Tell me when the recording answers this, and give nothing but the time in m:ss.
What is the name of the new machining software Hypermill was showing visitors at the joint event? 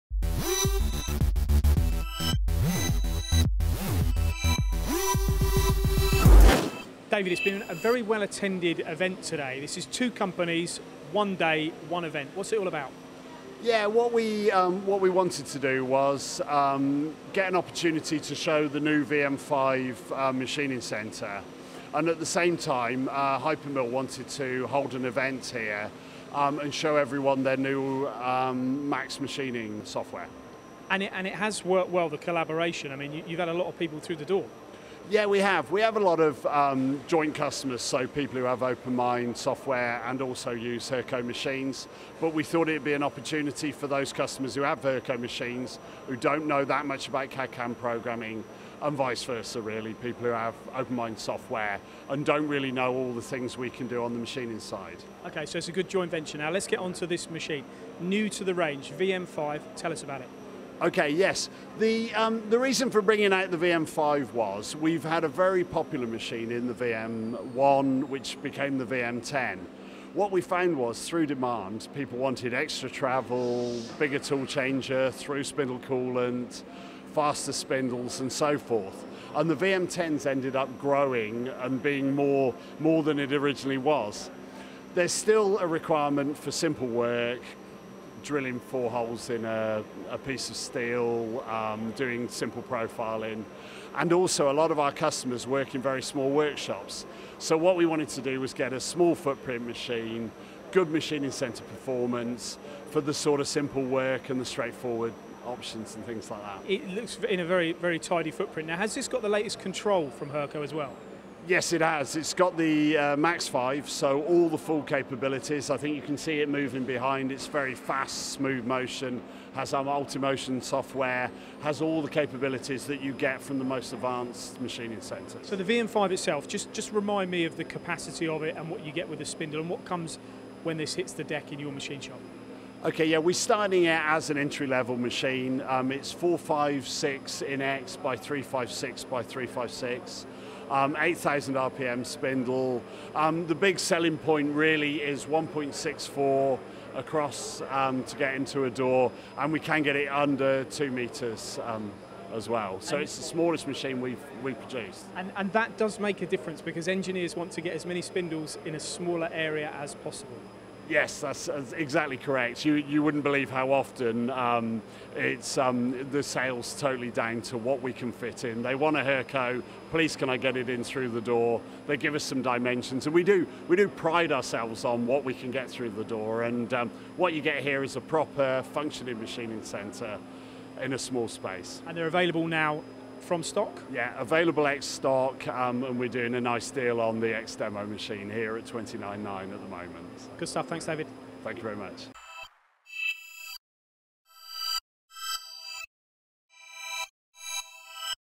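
0:28.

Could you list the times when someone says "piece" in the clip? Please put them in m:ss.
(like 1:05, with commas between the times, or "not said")
1:30.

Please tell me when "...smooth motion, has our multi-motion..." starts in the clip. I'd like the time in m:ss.
1:58.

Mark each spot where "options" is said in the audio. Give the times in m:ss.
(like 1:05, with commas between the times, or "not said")
1:45.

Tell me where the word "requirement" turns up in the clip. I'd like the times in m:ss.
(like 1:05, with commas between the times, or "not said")
1:25.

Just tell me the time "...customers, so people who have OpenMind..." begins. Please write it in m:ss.
0:37.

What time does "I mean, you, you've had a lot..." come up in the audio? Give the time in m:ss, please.
0:32.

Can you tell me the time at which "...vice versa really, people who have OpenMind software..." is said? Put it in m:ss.
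0:48.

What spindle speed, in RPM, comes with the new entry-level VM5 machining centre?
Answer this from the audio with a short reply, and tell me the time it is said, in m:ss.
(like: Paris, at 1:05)
8,000 RPM, at 2:20.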